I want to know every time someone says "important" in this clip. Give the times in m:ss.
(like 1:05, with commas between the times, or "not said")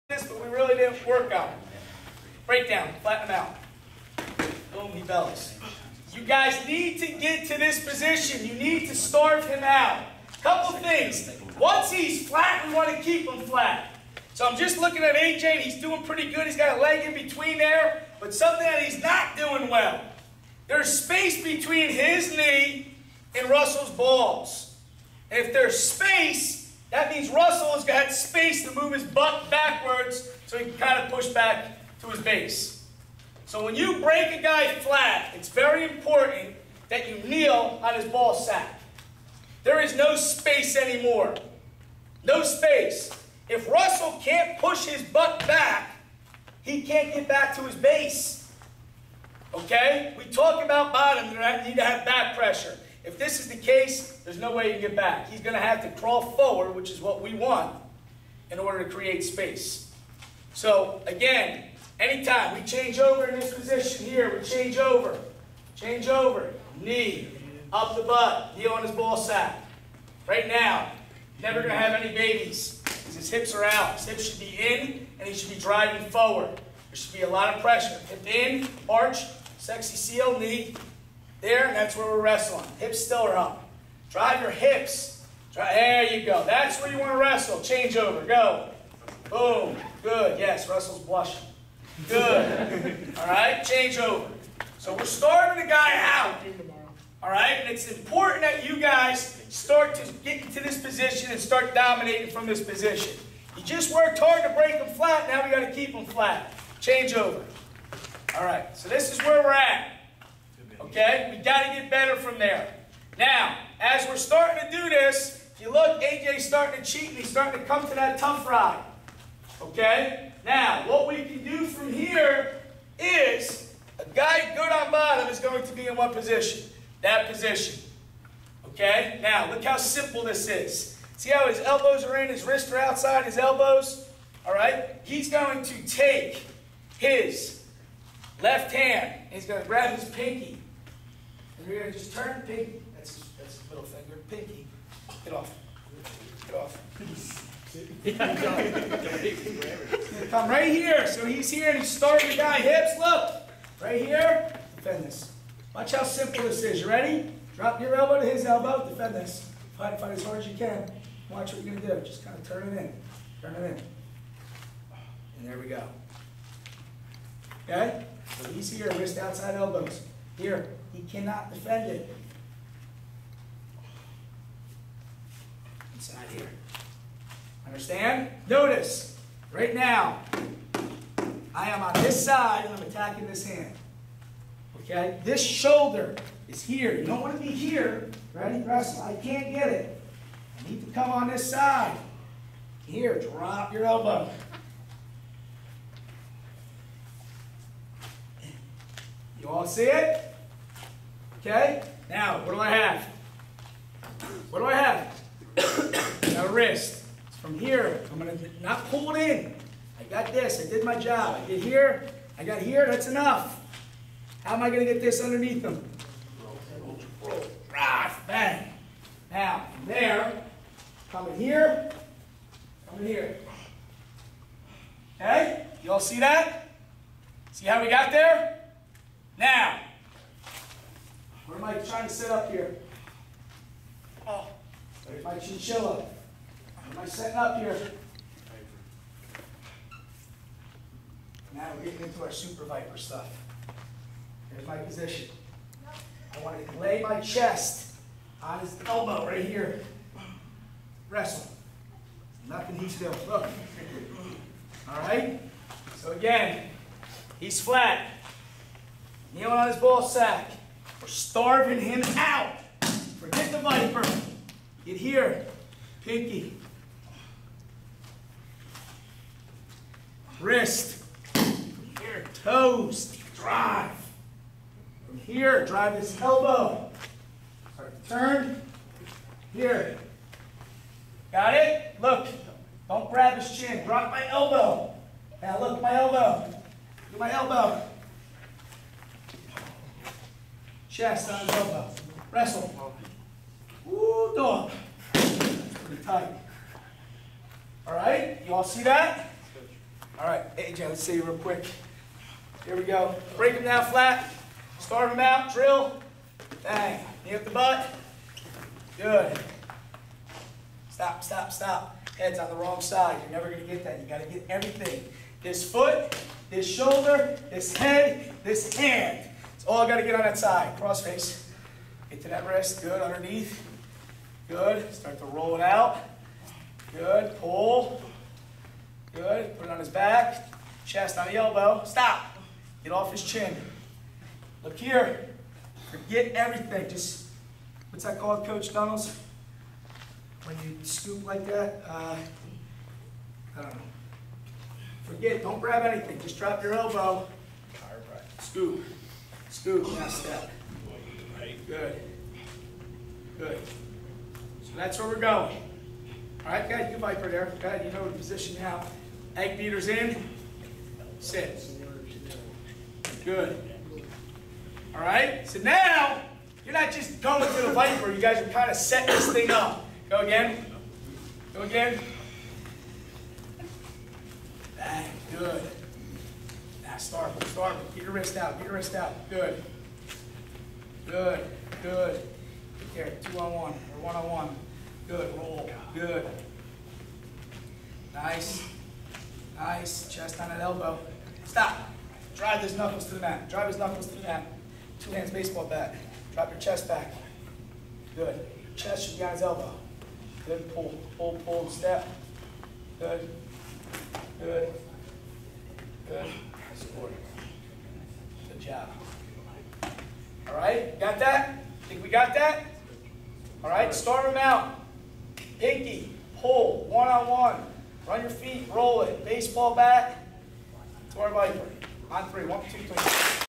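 0:35, 1:37.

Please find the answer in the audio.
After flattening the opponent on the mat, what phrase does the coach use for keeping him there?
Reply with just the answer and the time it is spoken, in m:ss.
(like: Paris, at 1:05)
starve him out, at 0:08.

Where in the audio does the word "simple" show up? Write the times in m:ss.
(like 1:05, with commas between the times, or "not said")
2:09, 2:36.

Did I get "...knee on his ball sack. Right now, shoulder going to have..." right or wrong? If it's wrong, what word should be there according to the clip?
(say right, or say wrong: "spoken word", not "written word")
wrong: "never", not "shoulder".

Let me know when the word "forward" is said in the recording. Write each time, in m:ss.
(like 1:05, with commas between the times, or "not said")
0:56, 1:16.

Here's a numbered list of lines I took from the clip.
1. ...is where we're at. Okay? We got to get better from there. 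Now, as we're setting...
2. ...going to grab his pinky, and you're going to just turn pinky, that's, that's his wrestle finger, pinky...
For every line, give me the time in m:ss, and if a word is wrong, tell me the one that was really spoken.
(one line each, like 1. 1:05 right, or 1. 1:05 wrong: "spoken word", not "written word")
1. 1:49 wrong: "starting", not "setting"
2. 2:19 wrong: "middle", not "wrestle".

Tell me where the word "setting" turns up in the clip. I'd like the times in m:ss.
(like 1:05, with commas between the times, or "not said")
3:57, 6:08.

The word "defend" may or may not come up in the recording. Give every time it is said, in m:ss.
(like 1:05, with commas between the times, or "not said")
2:34, 2:38, 2:51.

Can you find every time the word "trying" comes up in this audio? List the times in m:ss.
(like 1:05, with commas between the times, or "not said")
3:51.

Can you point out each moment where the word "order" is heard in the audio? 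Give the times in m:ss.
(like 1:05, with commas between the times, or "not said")
0:58.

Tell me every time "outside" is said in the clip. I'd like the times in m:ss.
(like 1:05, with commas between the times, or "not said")
2:12, 2:49.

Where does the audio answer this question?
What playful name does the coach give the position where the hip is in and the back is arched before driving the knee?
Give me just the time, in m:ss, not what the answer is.
1:19.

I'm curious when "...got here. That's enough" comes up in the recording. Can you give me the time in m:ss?
3:32.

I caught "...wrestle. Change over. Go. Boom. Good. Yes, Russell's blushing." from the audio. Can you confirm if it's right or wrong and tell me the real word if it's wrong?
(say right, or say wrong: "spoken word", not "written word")
right.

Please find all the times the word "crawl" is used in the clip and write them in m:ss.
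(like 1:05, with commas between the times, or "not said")
0:56.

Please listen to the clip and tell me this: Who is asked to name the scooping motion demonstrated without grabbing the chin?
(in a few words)
Coach Donalds.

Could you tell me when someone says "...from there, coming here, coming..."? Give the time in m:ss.
3:39.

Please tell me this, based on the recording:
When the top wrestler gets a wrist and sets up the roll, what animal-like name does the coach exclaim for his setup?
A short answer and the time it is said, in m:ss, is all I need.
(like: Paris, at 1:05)
chinchilla, at 3:55.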